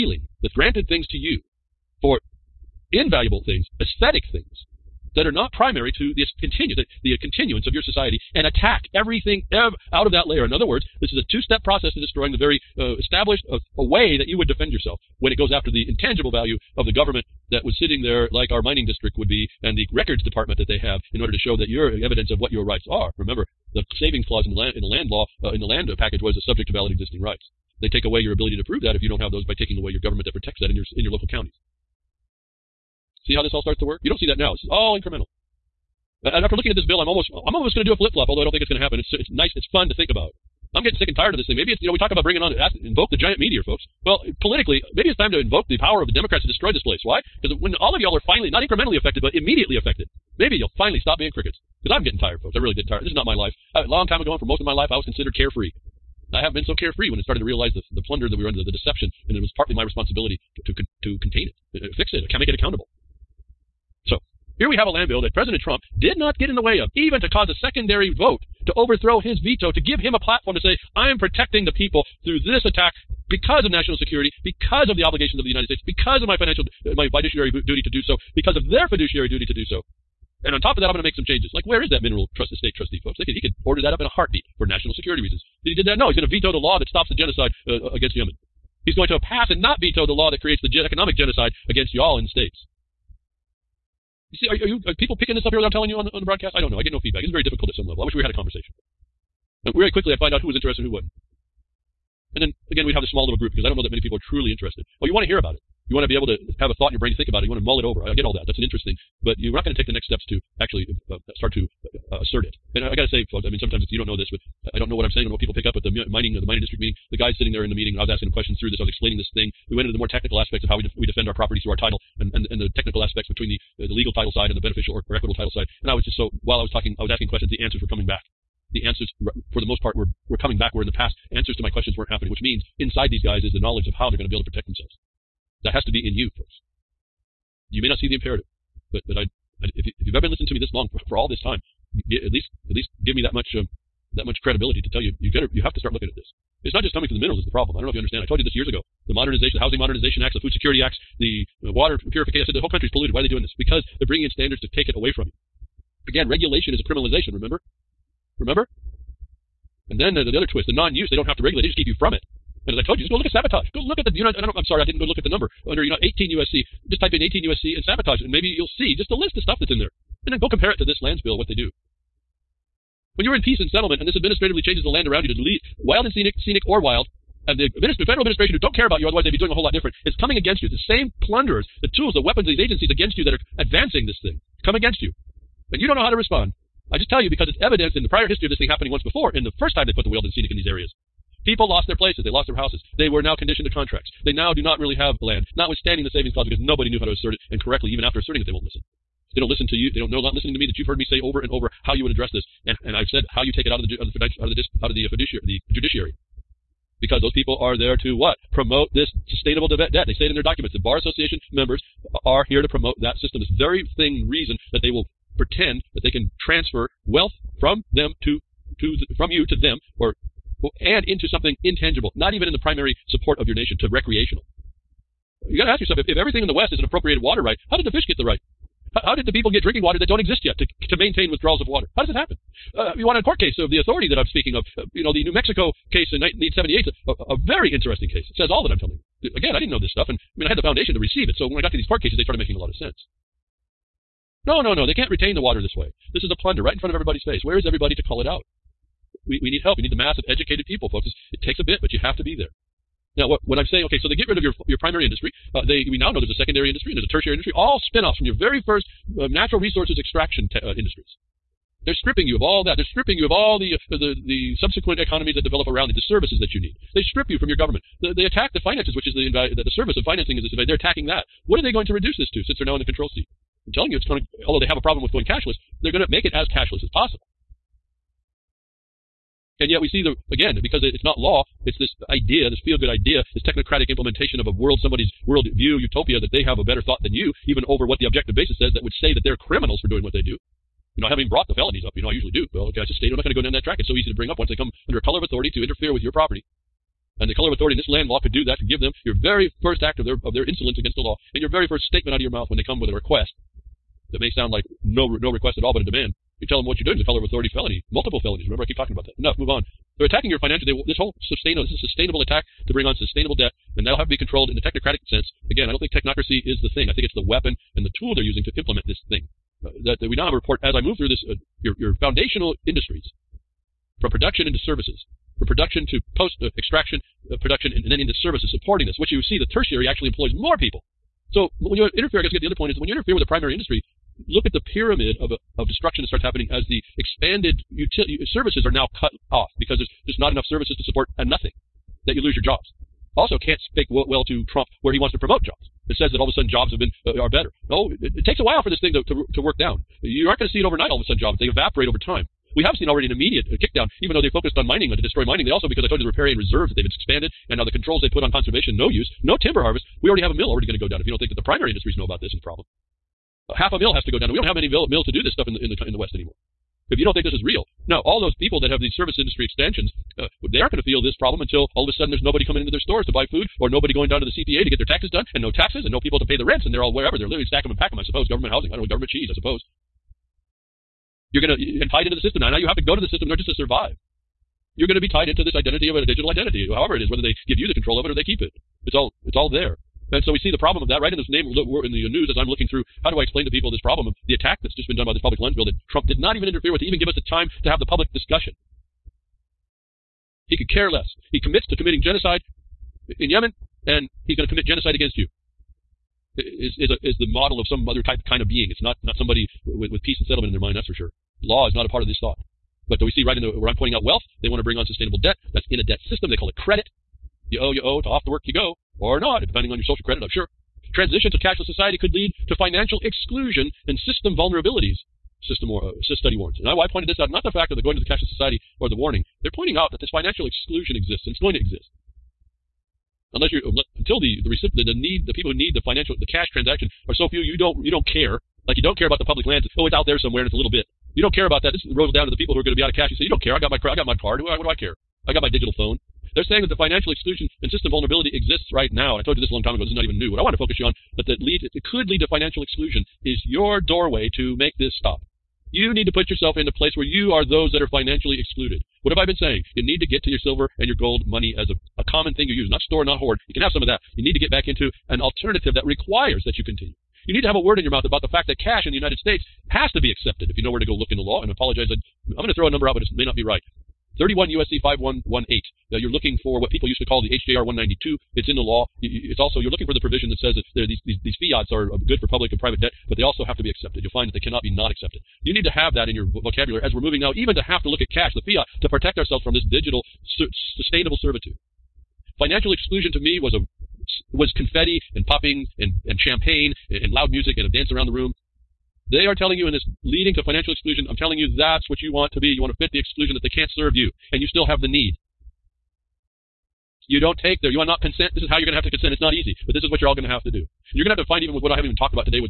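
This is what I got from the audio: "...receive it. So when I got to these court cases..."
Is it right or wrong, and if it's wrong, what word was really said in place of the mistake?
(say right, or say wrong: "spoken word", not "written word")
right.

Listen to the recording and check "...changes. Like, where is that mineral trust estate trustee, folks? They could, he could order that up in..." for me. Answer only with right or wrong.
right.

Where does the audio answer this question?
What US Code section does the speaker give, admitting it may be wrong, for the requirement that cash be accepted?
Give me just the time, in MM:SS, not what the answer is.
07:54.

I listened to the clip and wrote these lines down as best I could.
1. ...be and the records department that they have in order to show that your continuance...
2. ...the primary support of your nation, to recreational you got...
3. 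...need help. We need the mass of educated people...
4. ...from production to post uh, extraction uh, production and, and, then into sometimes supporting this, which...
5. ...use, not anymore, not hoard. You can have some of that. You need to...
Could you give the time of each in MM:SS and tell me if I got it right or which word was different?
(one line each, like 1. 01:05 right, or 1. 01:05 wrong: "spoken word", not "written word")
1. 00:19 wrong: "evidence", not "continuance"
2. 03:42 right
3. 04:09 right
4. 05:25 wrong: "services", not "sometimes"
5. 07:42 wrong: "store", not "anymore".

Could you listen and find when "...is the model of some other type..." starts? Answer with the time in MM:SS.
06:47.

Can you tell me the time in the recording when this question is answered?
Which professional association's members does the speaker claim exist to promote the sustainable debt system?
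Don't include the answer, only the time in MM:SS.
03:30.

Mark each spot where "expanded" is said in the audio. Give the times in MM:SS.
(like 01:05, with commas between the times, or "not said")
05:36, 05:56.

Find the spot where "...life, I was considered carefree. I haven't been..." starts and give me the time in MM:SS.
00:54.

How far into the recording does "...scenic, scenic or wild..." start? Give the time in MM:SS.
02:56.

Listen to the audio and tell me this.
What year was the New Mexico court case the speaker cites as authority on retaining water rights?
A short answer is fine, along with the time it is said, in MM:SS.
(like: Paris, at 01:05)
1978, at 03:56.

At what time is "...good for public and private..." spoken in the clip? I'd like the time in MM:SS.
08:01.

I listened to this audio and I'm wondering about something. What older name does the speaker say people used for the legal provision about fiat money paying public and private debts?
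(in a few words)
HJR 192.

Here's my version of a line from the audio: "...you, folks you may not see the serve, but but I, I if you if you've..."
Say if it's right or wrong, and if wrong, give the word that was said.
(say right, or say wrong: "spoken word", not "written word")
wrong: "imperative", not "serve".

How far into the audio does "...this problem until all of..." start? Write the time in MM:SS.
06:11.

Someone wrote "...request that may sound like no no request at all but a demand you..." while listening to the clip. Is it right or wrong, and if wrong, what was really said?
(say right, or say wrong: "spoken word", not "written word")
right.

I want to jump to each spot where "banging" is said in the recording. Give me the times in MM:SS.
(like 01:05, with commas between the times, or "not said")
not said.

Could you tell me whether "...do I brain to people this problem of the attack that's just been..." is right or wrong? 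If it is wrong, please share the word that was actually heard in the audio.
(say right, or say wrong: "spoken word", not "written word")
wrong: "explain", not "brain".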